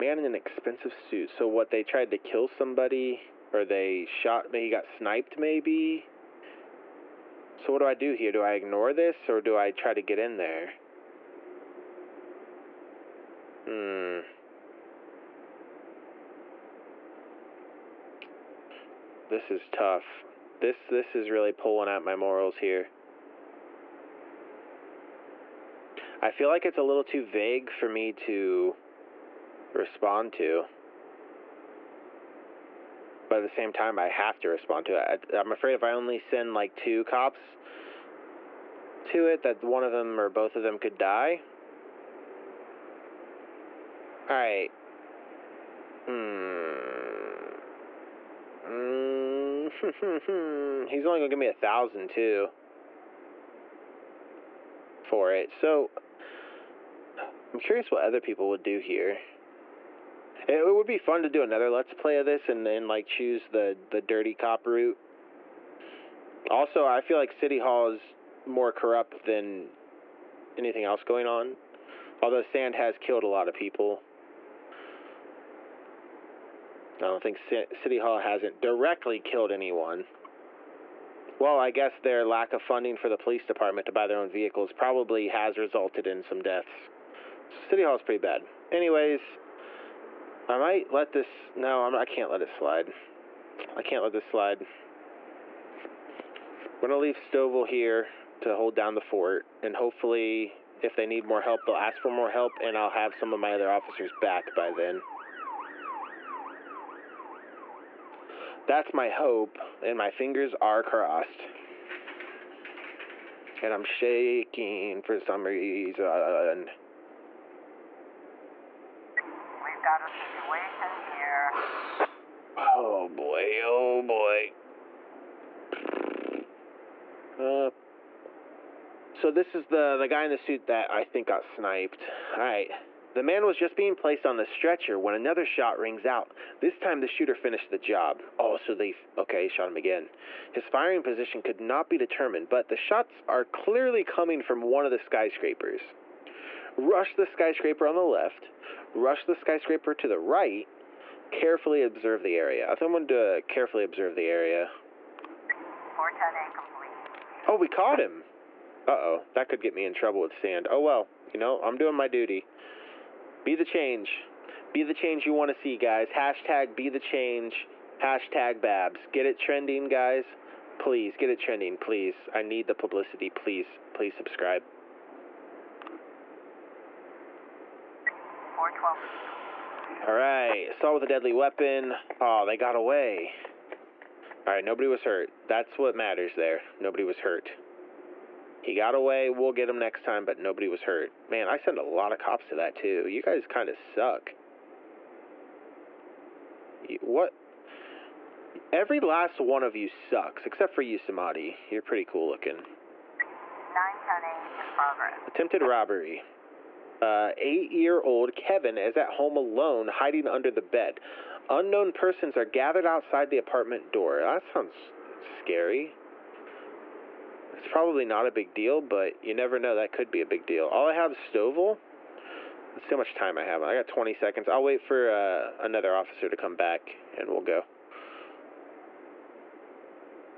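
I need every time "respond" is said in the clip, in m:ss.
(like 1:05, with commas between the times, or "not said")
0:29, 0:34.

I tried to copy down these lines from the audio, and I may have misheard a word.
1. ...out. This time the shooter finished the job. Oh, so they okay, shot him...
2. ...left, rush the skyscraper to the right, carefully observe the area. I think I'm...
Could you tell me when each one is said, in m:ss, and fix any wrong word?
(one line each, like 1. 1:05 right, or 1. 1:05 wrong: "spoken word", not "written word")
1. 2:16 right
2. 2:28 right.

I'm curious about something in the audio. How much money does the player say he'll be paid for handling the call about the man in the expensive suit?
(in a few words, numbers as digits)
1000.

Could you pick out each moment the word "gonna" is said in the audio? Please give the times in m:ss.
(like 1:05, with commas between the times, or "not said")
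0:51, 1:36.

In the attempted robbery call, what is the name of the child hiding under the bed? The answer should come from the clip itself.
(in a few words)
Kevin.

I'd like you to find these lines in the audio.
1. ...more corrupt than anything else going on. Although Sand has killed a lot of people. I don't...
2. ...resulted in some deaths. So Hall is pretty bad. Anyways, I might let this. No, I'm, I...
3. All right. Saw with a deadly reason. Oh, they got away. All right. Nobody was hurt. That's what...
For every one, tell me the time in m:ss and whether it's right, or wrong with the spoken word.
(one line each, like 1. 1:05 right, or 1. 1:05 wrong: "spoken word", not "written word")
1. 1:08 right
2. 1:25 wrong: "City", not "Hall"
3. 3:00 wrong: "weapon", not "reason".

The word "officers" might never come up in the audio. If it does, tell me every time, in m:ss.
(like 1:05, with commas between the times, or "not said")
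1:43, 3:45.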